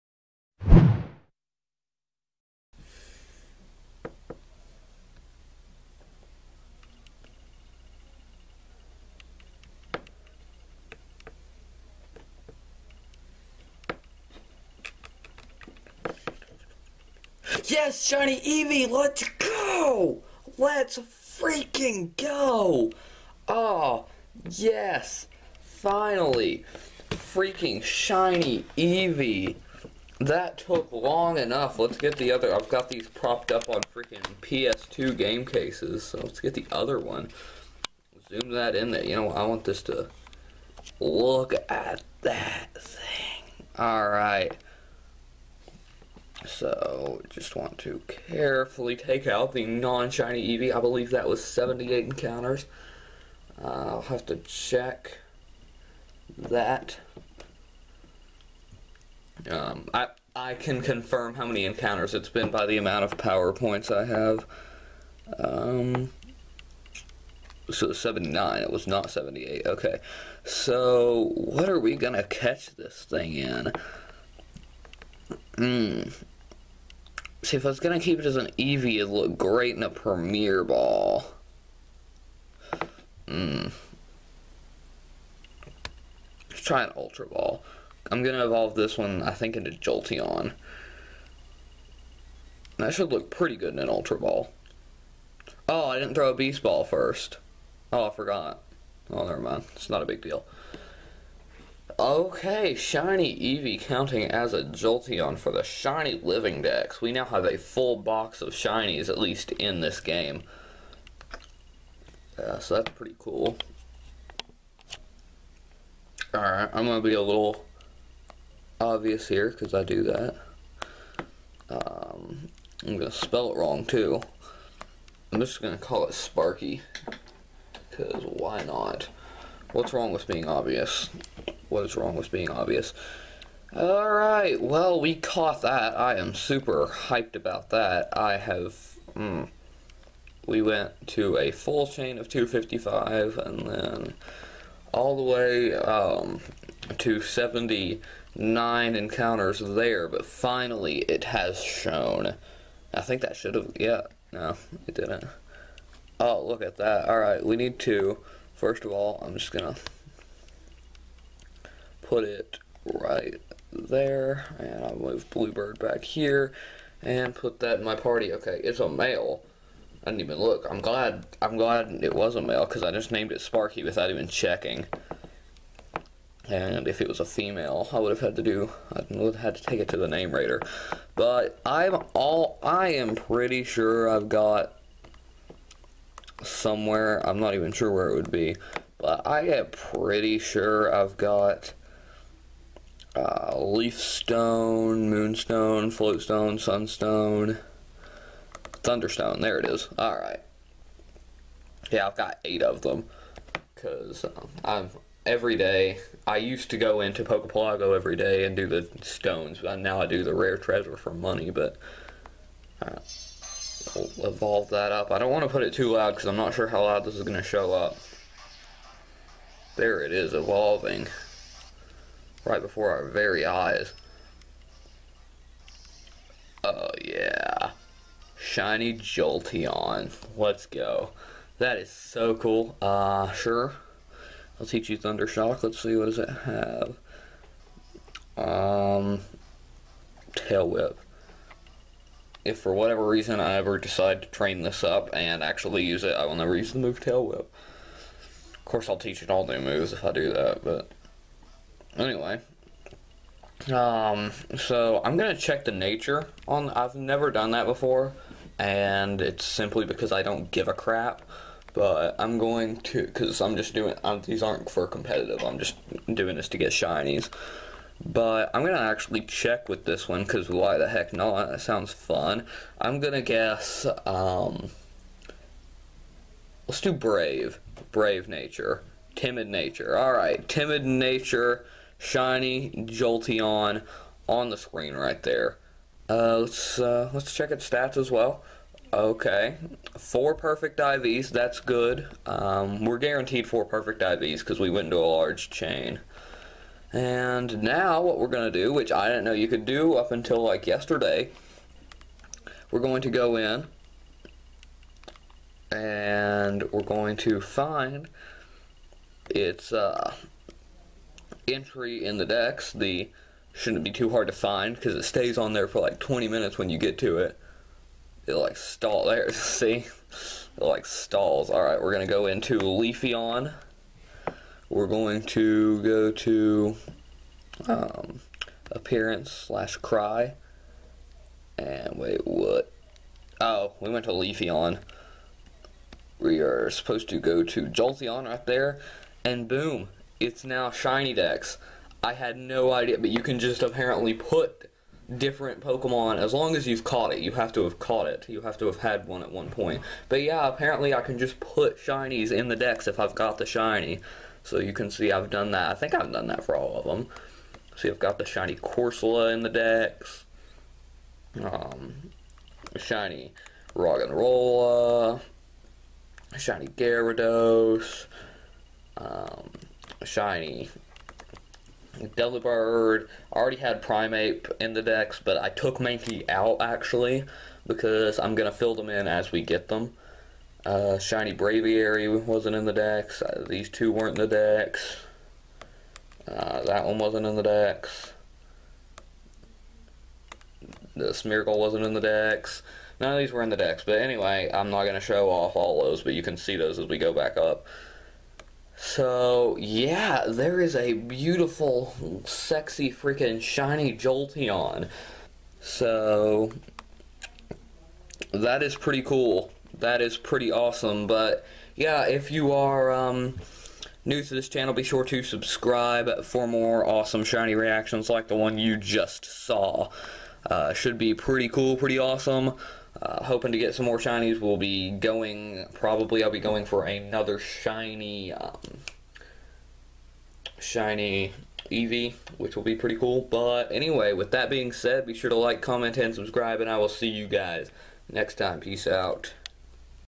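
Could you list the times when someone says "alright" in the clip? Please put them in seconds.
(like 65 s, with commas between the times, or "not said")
43 s, 116 s, 133 s, 157 s, 279 s, 321 s.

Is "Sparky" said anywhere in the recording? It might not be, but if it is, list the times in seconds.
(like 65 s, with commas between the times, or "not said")
126 s, 173 s.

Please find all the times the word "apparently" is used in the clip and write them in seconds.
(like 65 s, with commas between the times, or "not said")
343 s, 350 s.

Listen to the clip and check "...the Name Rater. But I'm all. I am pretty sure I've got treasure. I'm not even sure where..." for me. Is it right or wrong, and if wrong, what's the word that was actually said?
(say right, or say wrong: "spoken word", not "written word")
wrong: "somewhere", not "treasure".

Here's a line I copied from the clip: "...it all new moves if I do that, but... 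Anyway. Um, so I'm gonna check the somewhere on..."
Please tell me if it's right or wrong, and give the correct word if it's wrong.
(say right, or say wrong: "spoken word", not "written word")
wrong: "nature", not "somewhere".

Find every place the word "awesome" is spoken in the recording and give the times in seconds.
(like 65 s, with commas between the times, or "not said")
410 s, 416 s, 421 s.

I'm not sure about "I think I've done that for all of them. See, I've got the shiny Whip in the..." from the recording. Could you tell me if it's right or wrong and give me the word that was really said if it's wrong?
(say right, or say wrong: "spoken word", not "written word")
wrong: "Corsola", not "Whip".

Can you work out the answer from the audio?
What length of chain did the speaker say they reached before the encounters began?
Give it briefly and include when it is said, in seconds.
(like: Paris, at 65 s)
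255, at 142 s.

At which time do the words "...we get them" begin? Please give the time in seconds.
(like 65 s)
379 s.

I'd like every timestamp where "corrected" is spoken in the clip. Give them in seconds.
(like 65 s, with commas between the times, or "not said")
not said.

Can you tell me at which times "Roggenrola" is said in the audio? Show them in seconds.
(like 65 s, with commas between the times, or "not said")
363 s.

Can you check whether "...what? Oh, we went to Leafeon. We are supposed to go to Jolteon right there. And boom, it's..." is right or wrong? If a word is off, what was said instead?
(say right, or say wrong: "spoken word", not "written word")
right.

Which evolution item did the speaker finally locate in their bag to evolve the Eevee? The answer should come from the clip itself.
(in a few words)
Thunderstone.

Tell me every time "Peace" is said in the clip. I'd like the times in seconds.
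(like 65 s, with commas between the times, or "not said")
438 s.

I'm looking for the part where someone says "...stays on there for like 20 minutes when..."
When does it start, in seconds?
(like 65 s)
315 s.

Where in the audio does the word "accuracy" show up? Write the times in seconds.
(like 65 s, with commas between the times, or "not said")
not said.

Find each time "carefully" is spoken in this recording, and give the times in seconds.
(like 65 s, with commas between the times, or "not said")
48 s.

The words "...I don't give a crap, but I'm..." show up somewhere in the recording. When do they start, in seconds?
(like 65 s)
260 s.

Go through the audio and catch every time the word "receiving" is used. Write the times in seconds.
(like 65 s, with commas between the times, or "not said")
not said.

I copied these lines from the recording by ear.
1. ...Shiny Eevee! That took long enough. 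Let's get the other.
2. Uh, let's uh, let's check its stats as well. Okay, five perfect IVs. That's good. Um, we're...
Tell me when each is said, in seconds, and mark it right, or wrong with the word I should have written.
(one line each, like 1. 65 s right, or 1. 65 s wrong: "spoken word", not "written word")
1. 27 s right
2. 286 s wrong: "four", not "five".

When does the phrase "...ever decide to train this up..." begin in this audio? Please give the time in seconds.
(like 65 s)
243 s.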